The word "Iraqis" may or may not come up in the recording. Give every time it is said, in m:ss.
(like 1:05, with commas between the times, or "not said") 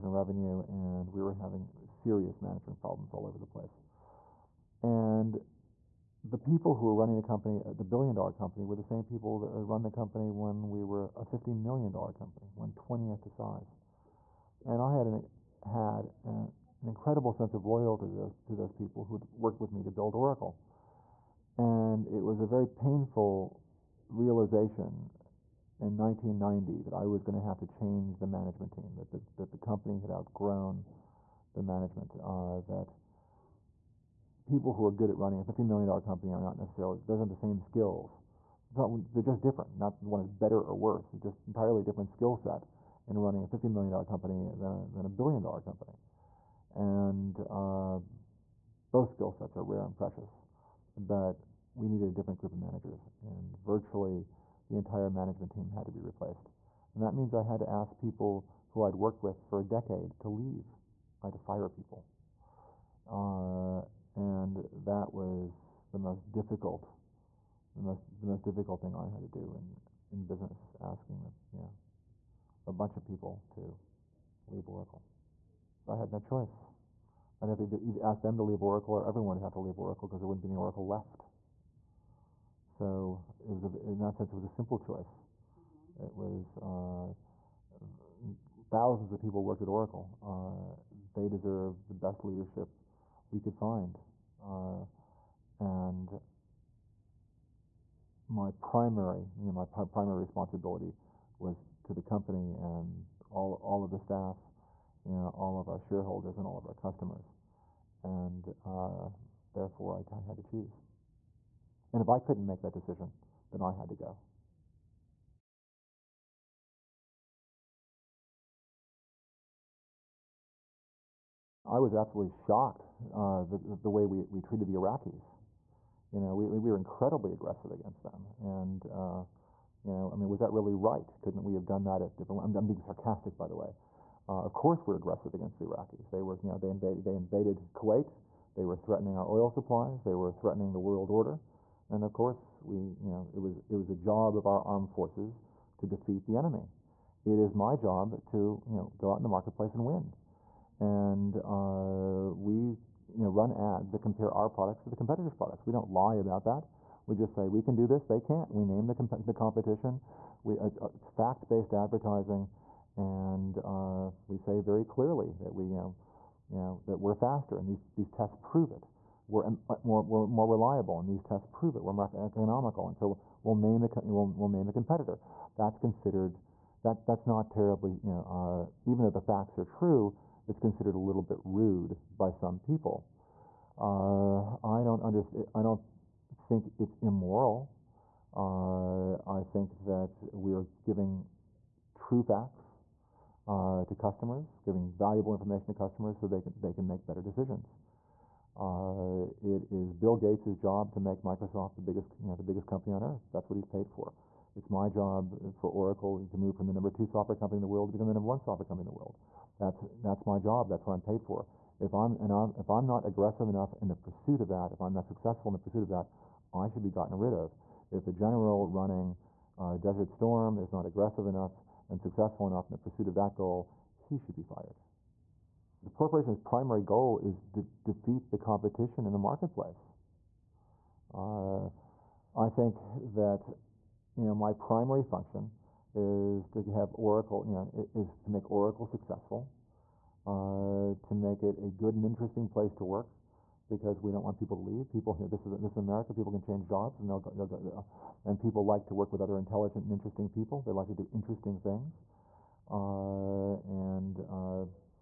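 2:04, 2:15.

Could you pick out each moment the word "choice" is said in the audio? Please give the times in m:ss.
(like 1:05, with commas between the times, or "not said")
1:16, 1:24.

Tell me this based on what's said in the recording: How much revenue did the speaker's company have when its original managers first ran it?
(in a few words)
$50 million.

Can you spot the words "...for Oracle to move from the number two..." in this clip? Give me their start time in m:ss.
3:25.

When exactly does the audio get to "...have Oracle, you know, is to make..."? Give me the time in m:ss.
3:56.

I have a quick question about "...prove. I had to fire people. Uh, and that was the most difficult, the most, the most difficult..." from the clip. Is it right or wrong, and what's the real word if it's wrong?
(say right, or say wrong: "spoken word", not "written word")
wrong: "leave", not "prove".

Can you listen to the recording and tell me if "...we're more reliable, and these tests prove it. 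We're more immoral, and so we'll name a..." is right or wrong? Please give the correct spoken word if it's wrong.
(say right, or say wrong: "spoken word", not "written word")
wrong: "economical", not "immoral".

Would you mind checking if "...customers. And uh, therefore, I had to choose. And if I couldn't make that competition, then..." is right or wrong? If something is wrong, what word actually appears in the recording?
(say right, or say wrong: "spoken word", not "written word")
wrong: "decision", not "competition".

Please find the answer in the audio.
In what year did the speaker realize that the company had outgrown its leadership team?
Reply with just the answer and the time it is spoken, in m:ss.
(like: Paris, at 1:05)
1990, at 0:25.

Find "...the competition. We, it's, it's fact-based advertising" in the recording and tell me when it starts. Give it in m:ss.
2:39.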